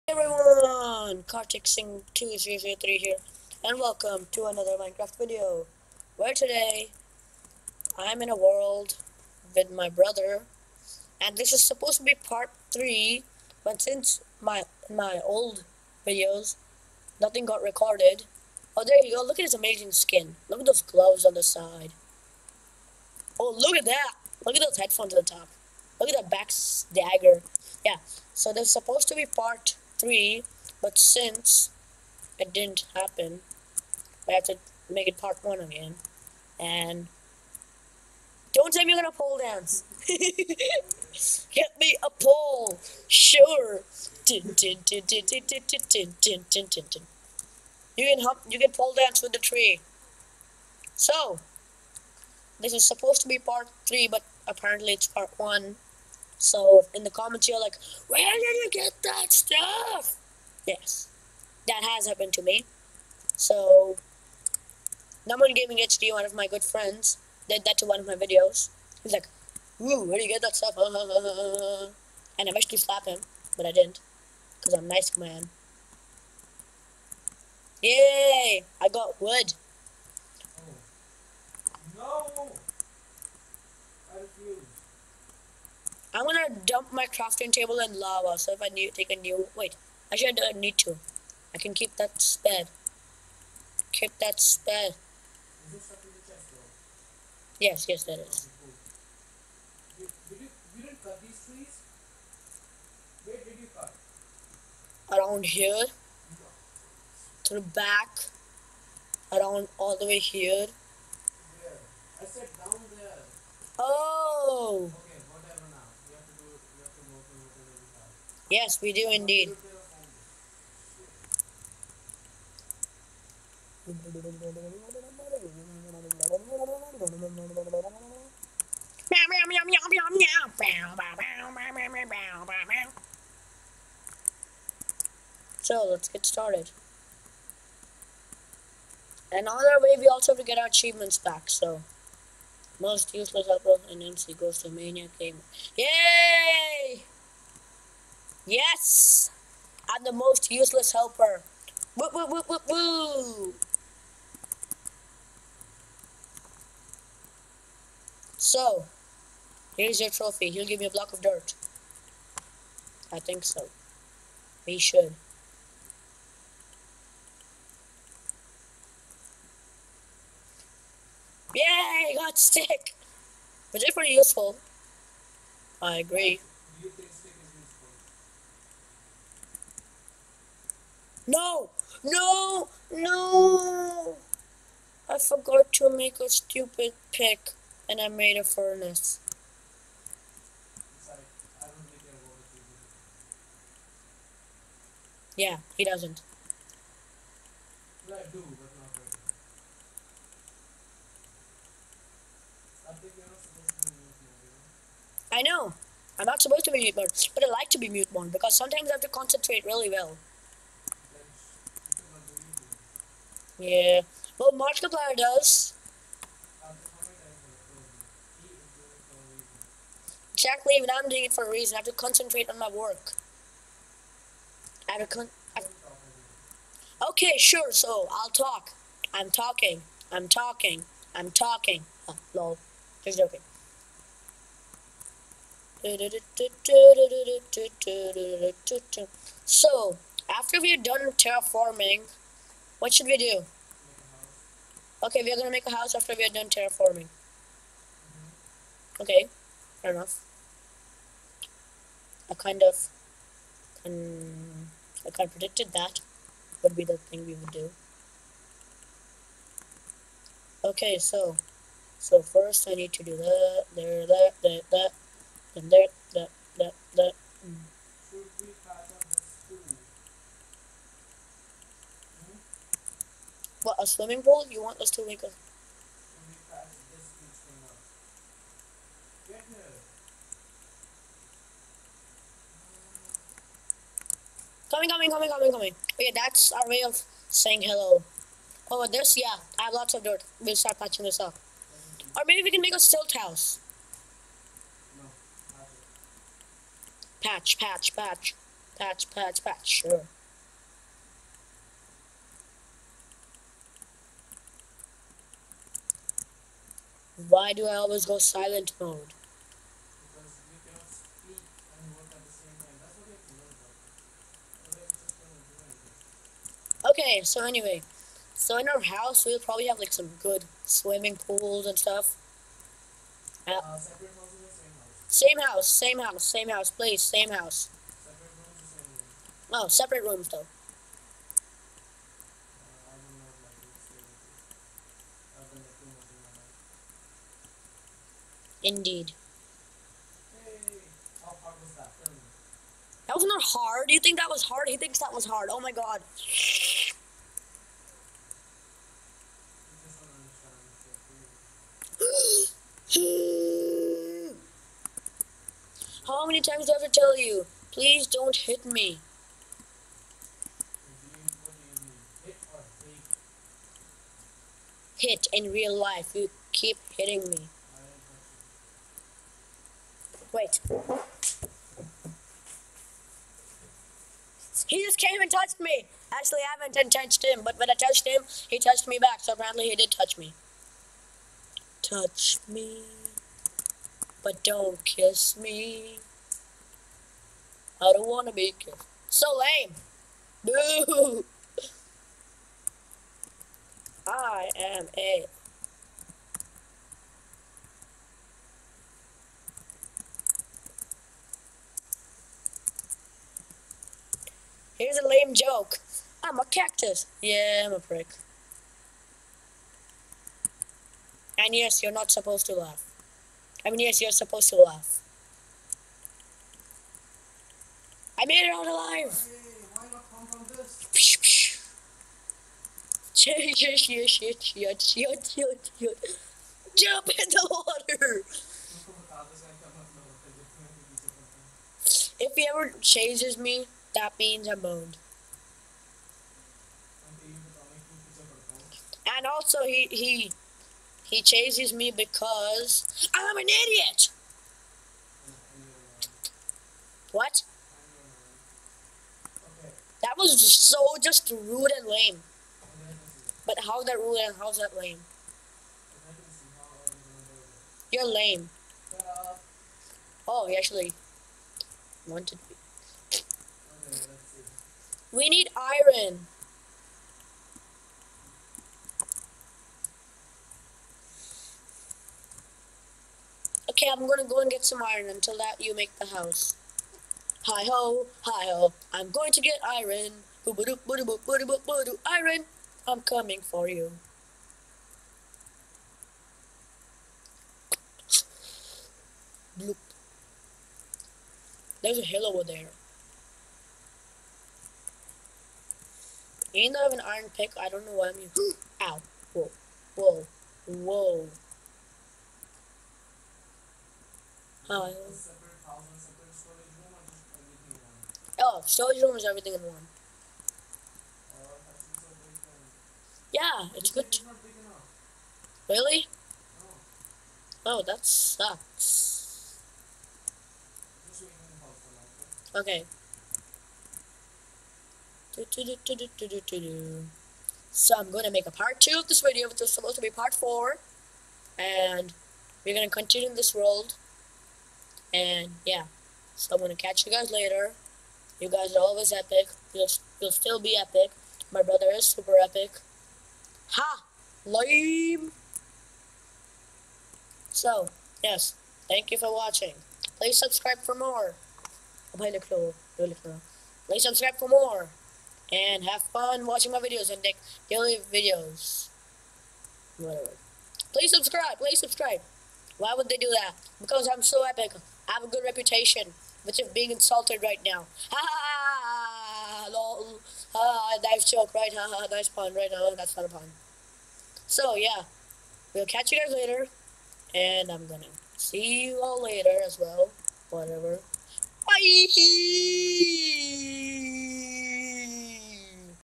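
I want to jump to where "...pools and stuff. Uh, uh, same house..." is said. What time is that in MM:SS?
05:21.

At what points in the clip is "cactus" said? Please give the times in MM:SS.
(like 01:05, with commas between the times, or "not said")
06:46.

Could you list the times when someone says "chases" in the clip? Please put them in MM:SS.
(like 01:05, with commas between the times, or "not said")
07:12, 07:21.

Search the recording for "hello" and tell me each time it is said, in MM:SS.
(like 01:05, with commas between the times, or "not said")
04:47.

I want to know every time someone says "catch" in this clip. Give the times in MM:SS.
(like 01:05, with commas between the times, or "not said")
08:56, 09:35.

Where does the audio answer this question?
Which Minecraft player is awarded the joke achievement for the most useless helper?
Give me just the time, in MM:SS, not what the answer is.
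02:24.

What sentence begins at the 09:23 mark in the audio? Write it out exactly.
Because I'm so epic have a good reputation, which is being insulted right now.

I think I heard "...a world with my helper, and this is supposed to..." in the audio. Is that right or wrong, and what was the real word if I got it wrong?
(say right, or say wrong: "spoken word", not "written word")
wrong: "brother", not "helper".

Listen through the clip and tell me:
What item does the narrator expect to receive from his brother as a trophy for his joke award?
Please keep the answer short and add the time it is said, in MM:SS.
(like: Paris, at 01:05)
a block of dirt, at 02:40.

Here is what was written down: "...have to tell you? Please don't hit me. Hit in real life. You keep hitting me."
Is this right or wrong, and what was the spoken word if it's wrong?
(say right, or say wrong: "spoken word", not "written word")
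right.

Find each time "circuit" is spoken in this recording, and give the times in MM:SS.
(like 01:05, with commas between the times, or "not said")
not said.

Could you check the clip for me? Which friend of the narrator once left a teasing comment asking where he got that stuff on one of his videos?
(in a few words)
Naman Gaming HD.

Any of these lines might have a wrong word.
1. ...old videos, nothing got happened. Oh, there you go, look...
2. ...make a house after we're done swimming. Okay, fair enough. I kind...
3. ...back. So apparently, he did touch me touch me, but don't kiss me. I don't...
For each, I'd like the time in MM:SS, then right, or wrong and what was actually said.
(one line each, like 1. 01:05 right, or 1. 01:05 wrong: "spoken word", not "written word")
1. 00:15 wrong: "recorded", not "happened"
2. 04:05 wrong: "terraforming", not "swimming"
3. 06:18 right.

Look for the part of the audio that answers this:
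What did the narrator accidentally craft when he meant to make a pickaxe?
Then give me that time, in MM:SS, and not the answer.
03:08.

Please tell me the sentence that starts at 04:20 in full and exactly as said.
Okay, so so first I need to do that, there, that, that, that, then there, that, that, that.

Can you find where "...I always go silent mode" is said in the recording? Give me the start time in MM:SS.
05:07.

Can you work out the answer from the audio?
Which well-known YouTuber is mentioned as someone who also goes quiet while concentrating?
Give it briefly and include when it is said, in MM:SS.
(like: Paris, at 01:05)
Markiplier, at 03:34.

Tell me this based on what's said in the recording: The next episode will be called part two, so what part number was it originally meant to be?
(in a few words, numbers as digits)
4.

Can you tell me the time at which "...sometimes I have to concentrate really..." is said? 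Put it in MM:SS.
03:28.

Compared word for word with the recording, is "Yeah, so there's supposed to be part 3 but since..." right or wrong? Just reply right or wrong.
right.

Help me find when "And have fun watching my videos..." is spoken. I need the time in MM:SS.
09:15.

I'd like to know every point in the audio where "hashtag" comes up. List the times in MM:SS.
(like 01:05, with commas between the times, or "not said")
not said.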